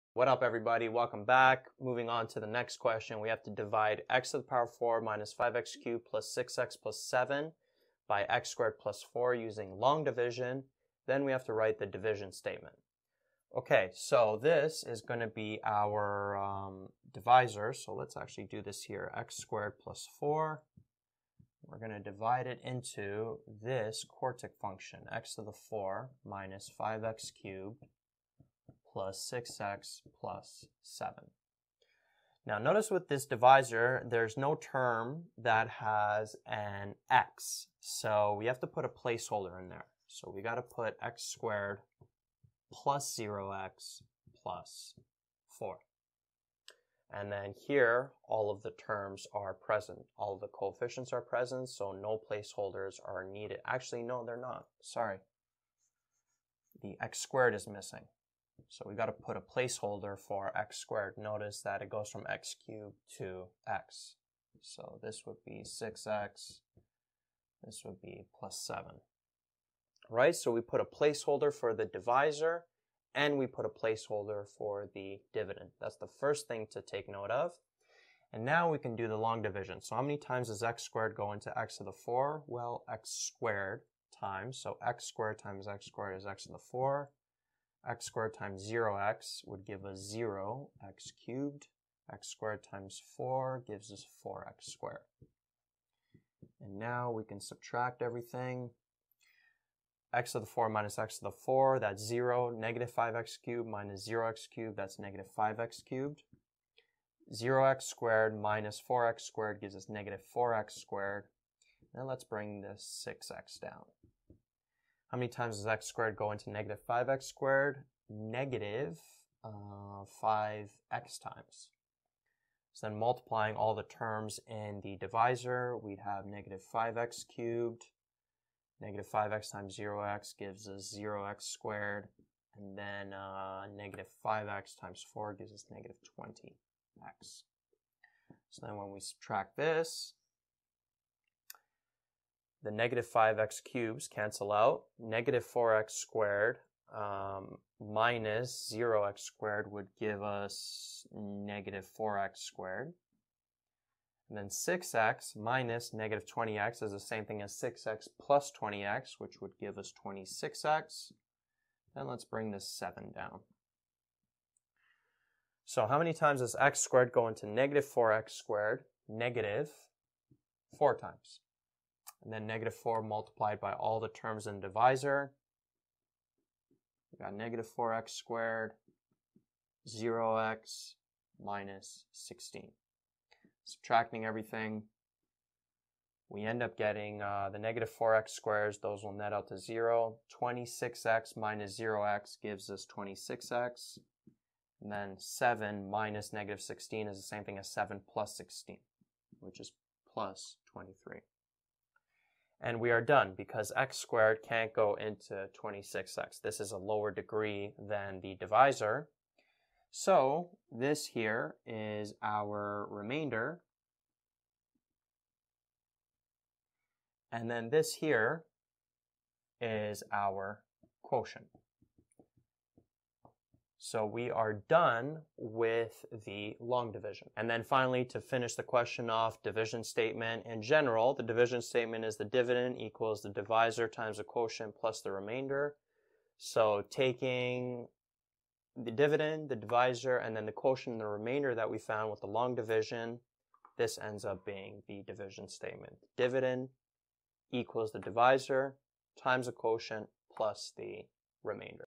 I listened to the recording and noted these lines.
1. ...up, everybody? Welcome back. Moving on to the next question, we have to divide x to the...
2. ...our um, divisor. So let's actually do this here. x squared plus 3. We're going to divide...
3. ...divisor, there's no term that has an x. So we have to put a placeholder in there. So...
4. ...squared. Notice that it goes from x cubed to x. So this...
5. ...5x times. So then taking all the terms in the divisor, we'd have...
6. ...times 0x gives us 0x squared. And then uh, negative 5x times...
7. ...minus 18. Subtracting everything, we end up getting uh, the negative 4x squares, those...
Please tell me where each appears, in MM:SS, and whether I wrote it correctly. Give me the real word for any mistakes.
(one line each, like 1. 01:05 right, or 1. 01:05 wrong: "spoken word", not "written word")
1. 00:00 right
2. 00:15 wrong: "4", not "3"
3. 00:33 right
4. 01:00 right
5. 02:00 wrong: "multiplying", not "taking"
6. 02:09 right
7. 03:01 wrong: "16", not "18".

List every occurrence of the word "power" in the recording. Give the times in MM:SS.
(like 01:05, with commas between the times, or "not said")
00:04.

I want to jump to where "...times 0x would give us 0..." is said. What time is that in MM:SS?
01:28.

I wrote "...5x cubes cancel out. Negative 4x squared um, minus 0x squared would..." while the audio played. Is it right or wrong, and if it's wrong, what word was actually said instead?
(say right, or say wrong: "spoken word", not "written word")
right.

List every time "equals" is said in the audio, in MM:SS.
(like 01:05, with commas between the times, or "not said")
03:52, 04:07.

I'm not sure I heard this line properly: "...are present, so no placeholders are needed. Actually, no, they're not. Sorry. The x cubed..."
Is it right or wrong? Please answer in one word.
wrong.